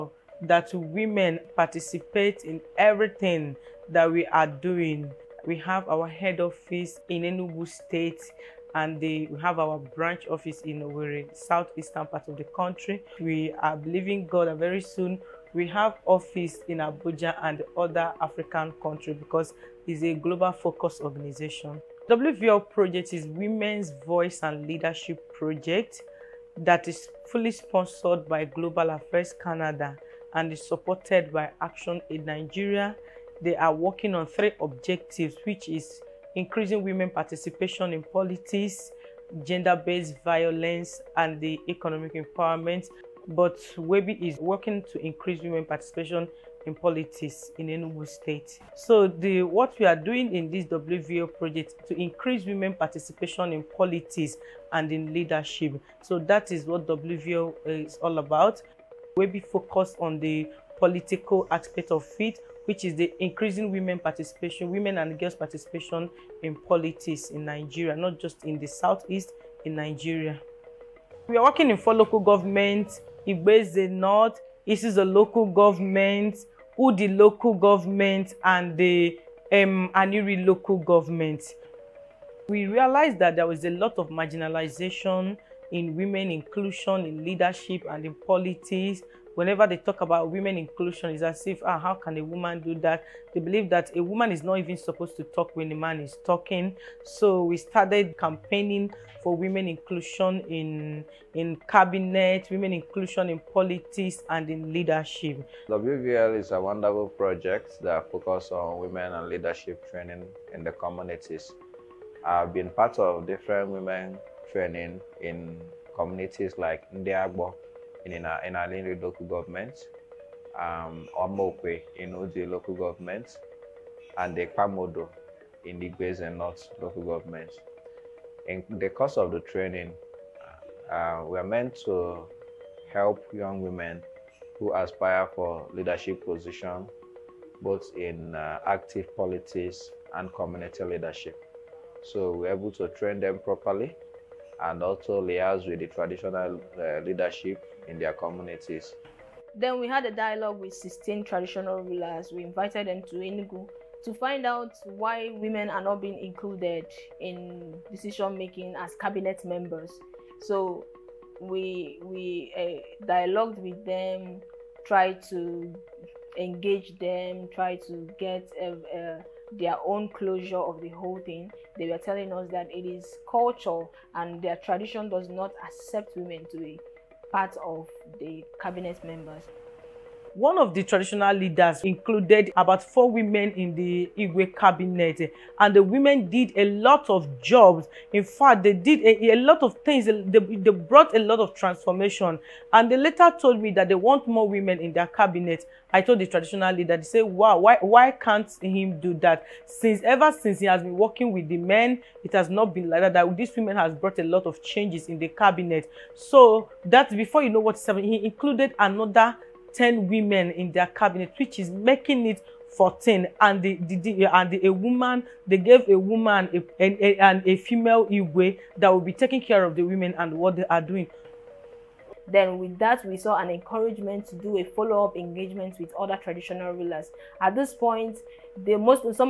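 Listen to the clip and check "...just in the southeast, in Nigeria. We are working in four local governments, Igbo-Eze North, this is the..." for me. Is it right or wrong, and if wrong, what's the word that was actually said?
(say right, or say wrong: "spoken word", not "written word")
right.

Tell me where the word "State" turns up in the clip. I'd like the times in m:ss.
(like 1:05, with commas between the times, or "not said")
0:07, 0:48.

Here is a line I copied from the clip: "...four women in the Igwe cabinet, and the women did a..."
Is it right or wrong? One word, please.
right.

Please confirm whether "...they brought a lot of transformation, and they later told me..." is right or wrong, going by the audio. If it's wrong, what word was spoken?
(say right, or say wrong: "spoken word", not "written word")
right.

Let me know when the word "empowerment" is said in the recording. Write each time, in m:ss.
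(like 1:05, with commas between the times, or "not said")
0:42.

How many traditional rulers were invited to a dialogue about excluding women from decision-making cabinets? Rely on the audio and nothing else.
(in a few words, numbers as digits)
16.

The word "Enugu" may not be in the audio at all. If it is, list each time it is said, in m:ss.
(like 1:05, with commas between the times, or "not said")
0:07, 0:47, 2:33.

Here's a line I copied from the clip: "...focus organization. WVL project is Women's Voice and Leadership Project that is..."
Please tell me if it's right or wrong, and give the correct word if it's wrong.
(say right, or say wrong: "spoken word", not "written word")
right.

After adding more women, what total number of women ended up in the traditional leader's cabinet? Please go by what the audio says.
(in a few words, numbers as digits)
14.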